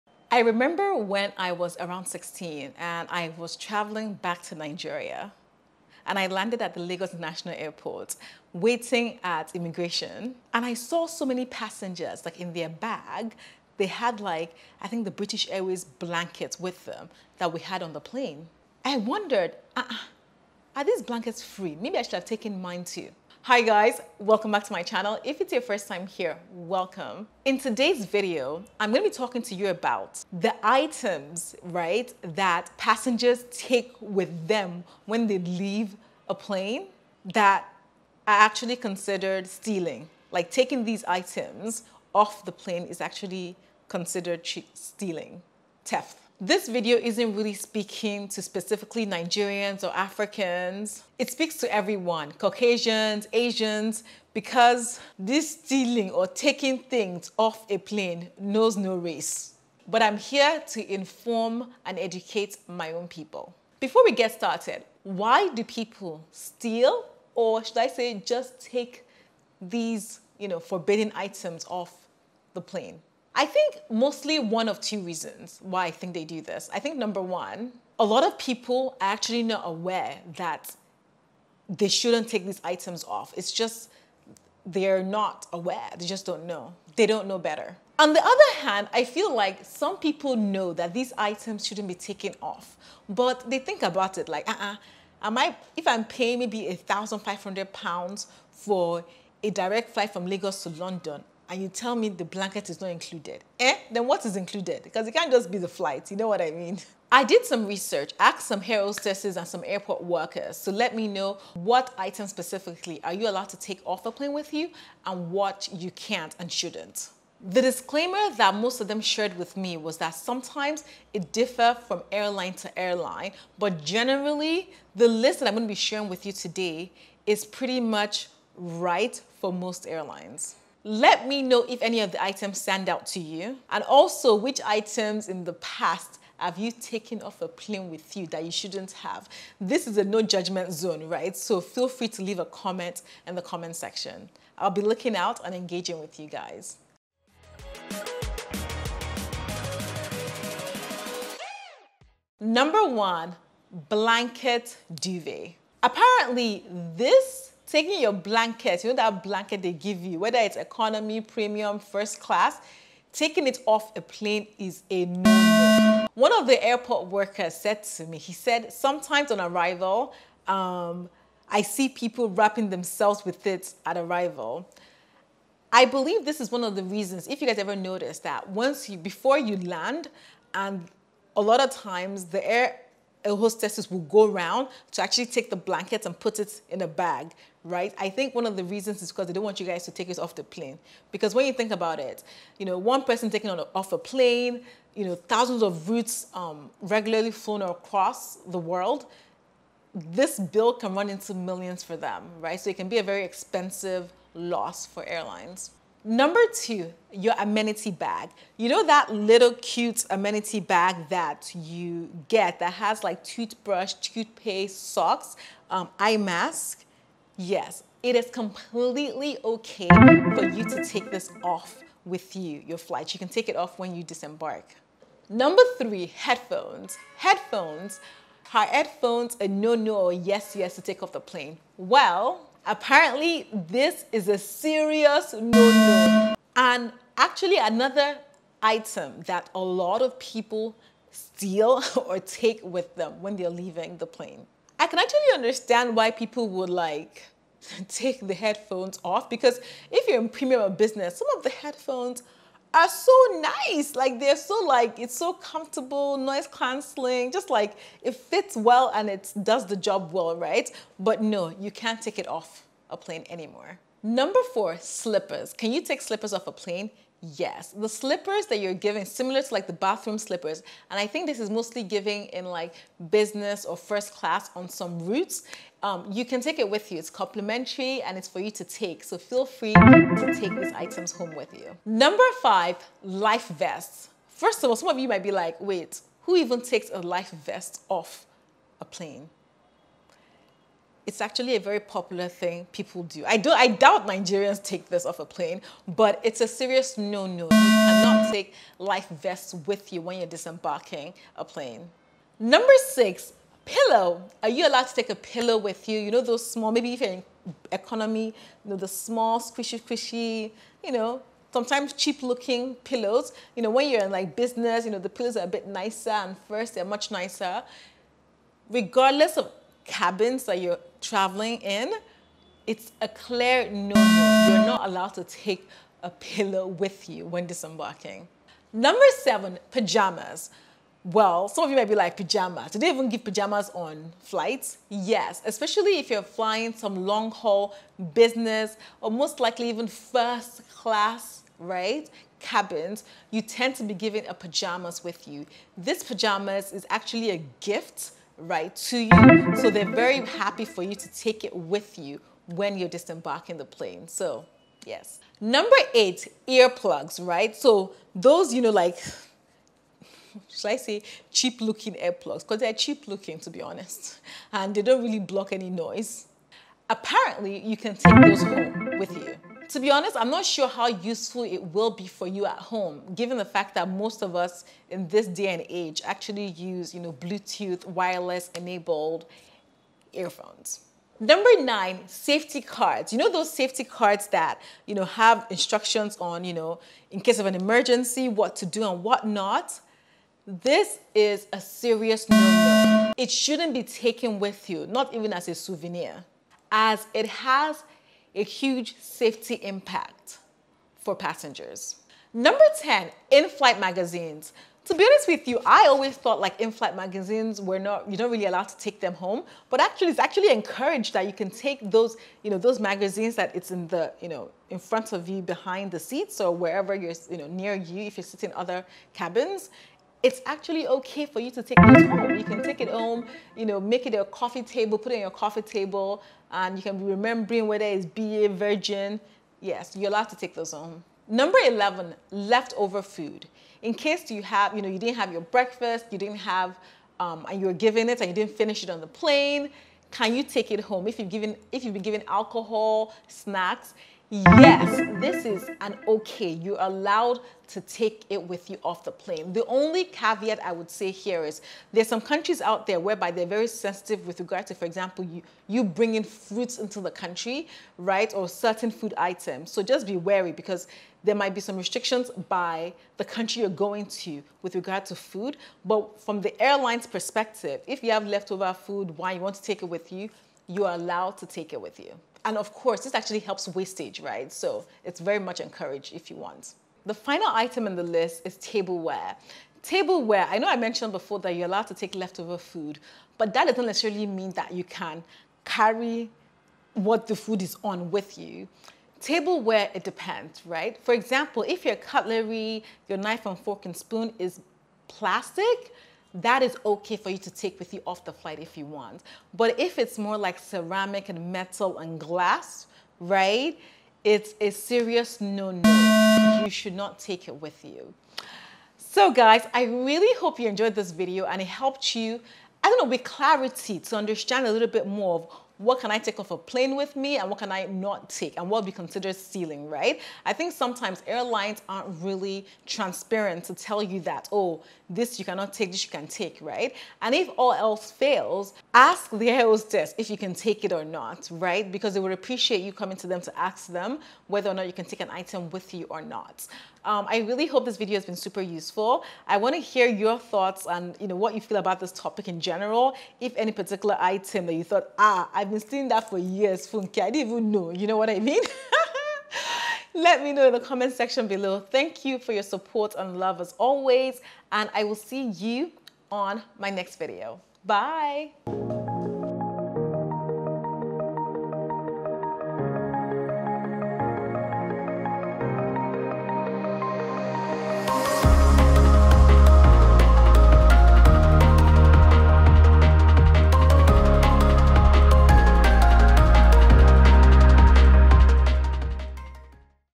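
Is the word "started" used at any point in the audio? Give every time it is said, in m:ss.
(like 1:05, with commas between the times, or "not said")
1:04.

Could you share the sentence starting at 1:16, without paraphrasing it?
I think number one, a lot of people are actually not aware that they shouldn't take these items off.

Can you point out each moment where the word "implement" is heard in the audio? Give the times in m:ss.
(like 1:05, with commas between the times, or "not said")
not said.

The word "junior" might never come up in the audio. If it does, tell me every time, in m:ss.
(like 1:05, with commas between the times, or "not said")
not said.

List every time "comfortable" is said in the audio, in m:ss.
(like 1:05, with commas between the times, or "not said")
4:15.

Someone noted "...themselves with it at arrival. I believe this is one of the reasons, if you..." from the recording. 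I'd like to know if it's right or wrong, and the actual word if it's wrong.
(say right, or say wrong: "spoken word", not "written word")
right.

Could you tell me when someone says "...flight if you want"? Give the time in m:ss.
8:18.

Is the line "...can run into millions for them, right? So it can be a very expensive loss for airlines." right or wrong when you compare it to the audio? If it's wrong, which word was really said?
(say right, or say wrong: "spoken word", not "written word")
right.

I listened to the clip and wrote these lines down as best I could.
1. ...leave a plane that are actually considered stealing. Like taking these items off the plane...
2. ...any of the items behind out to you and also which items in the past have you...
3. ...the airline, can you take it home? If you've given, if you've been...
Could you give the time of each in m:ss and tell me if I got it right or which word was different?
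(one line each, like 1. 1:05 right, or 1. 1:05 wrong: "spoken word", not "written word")
1. 0:35 right
2. 2:11 wrong: "stand", not "behind"
3. 7:19 wrong: "plane", not "airline".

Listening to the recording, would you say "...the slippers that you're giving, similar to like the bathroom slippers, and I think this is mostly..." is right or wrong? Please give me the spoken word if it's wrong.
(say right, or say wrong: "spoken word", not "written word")
right.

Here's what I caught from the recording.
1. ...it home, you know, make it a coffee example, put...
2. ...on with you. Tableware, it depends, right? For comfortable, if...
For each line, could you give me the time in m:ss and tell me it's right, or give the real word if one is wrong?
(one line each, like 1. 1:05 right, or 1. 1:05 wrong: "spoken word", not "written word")
1. 7:02 wrong: "table", not "example"
2. 8:07 wrong: "example", not "comfortable".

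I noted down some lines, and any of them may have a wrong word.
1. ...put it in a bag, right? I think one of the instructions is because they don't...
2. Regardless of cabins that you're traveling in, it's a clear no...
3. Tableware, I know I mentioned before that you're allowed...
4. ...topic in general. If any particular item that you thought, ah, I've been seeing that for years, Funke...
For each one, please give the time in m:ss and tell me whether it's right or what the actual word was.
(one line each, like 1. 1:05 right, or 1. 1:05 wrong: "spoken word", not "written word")
1. 3:06 wrong: "reasons", not "instructions"
2. 5:18 right
3. 7:59 right
4. 9:02 right.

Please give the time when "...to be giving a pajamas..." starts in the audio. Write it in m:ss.
5:43.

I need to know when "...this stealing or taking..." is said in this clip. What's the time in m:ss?
0:55.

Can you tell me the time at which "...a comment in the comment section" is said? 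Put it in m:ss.
2:22.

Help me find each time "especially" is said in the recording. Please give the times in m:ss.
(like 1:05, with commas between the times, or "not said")
5:35.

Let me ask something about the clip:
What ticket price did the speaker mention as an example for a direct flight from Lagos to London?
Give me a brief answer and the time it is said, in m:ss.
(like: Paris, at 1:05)
1,500 pounds, at 1:36.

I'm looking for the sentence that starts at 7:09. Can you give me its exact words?
Yes, you're allowed to take those home.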